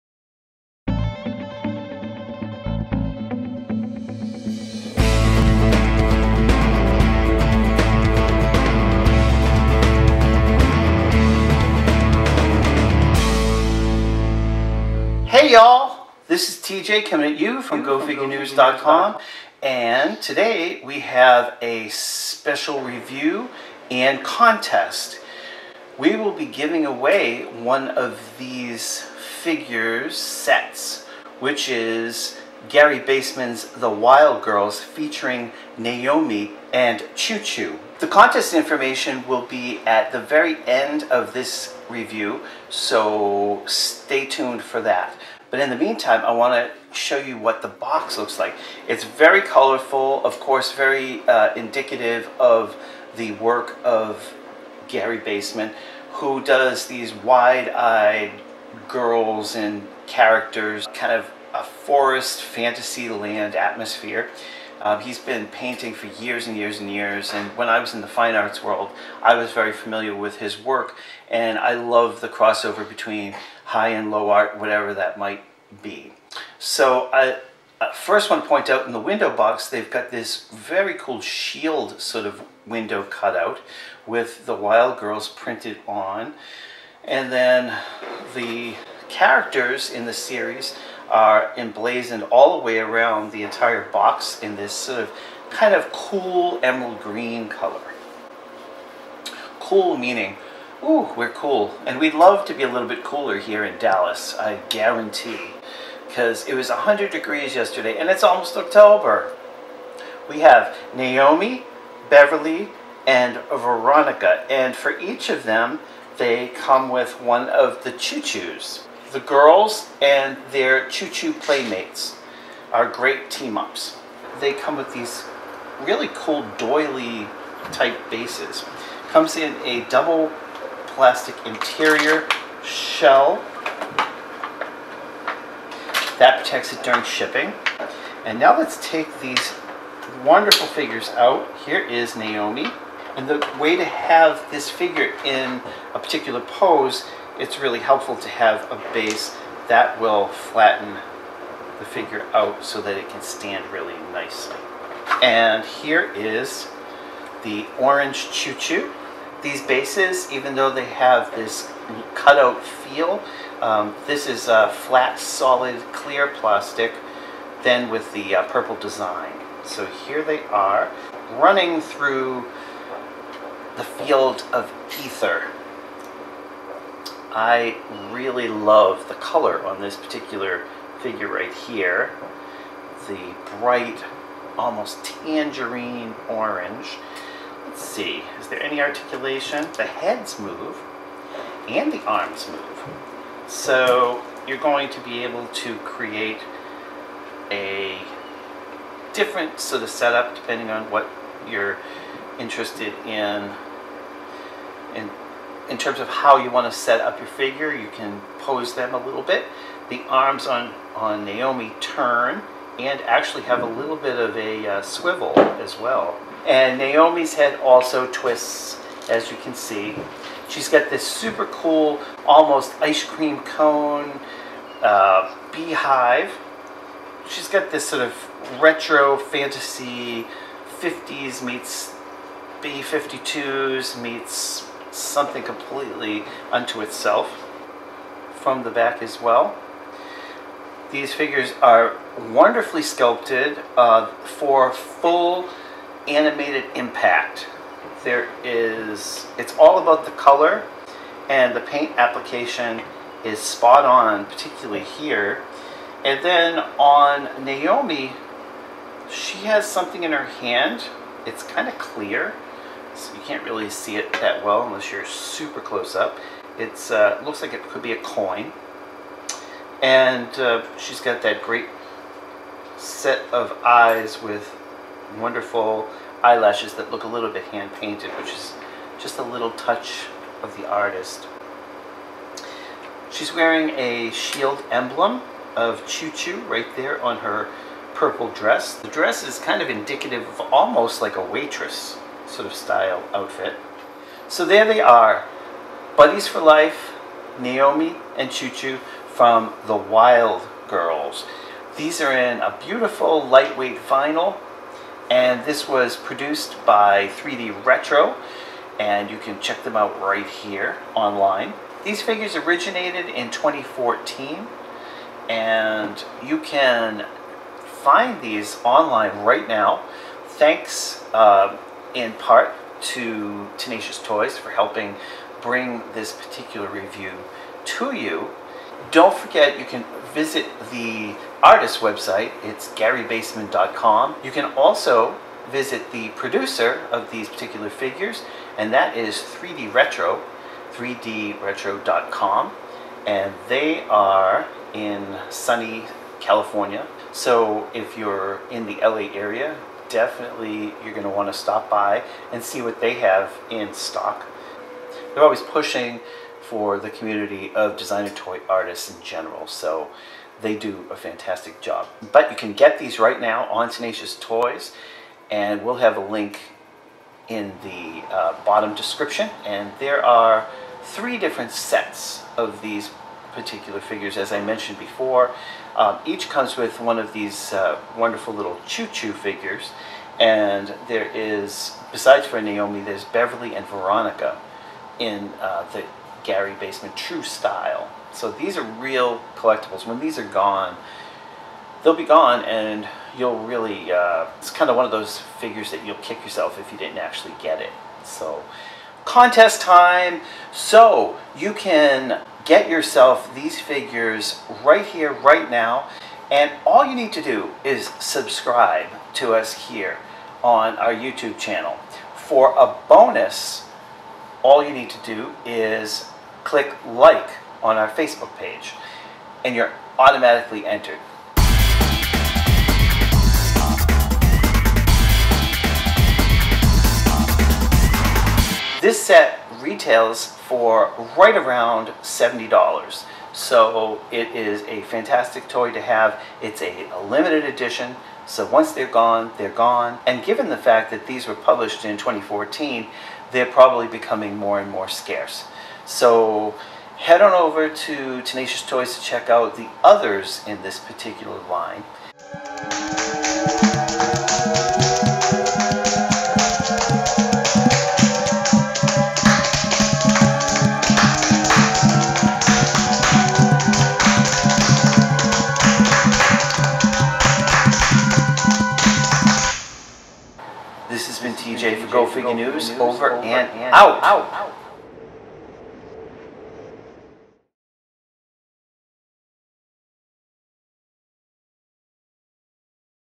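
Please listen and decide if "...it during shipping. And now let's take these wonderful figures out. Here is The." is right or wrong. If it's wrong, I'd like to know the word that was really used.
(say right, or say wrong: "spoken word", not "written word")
wrong: "Naomi", not "The".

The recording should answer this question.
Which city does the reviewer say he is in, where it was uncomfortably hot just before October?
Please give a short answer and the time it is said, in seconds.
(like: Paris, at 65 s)
Dallas, at 103 s.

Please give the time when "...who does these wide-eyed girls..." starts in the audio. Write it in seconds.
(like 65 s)
56 s.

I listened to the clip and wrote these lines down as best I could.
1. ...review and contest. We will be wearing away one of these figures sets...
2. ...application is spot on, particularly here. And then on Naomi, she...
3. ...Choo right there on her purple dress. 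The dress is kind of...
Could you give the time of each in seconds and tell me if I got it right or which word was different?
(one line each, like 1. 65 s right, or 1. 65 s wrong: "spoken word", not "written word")
1. 22 s wrong: "giving", not "wearing"
2. 251 s right
3. 286 s right.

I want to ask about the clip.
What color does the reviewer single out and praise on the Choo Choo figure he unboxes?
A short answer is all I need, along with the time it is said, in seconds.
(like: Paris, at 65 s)
Tangerine orange, at 185 s.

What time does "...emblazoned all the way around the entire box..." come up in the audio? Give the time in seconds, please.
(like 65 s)
91 s.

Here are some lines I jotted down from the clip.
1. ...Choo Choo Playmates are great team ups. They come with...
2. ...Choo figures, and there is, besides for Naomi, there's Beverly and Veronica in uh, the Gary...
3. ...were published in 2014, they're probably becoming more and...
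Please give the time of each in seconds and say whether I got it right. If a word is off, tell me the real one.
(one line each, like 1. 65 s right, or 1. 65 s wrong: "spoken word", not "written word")
1. 120 s right
2. 378 s right
3. 441 s right.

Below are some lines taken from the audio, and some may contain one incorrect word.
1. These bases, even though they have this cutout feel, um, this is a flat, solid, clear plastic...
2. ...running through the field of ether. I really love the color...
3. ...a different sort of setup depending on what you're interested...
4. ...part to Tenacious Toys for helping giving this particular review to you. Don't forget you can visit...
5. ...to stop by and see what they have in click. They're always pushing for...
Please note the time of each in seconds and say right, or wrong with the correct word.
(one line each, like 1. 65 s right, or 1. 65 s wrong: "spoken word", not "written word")
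1. 159 s right
2. 171 s right
3. 197 s right
4. 322 s wrong: "bring", not "giving"
5. 351 s wrong: "stock", not "click".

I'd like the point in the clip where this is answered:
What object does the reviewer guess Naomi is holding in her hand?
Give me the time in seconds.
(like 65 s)
268 s.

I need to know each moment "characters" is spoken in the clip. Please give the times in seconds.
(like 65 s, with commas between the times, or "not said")
60 s, 89 s.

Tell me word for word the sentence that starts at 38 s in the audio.
The contest information will be at the very end of this review, so stay tuned for that.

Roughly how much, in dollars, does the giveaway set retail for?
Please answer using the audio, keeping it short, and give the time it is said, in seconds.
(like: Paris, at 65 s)
$70, at 432 s.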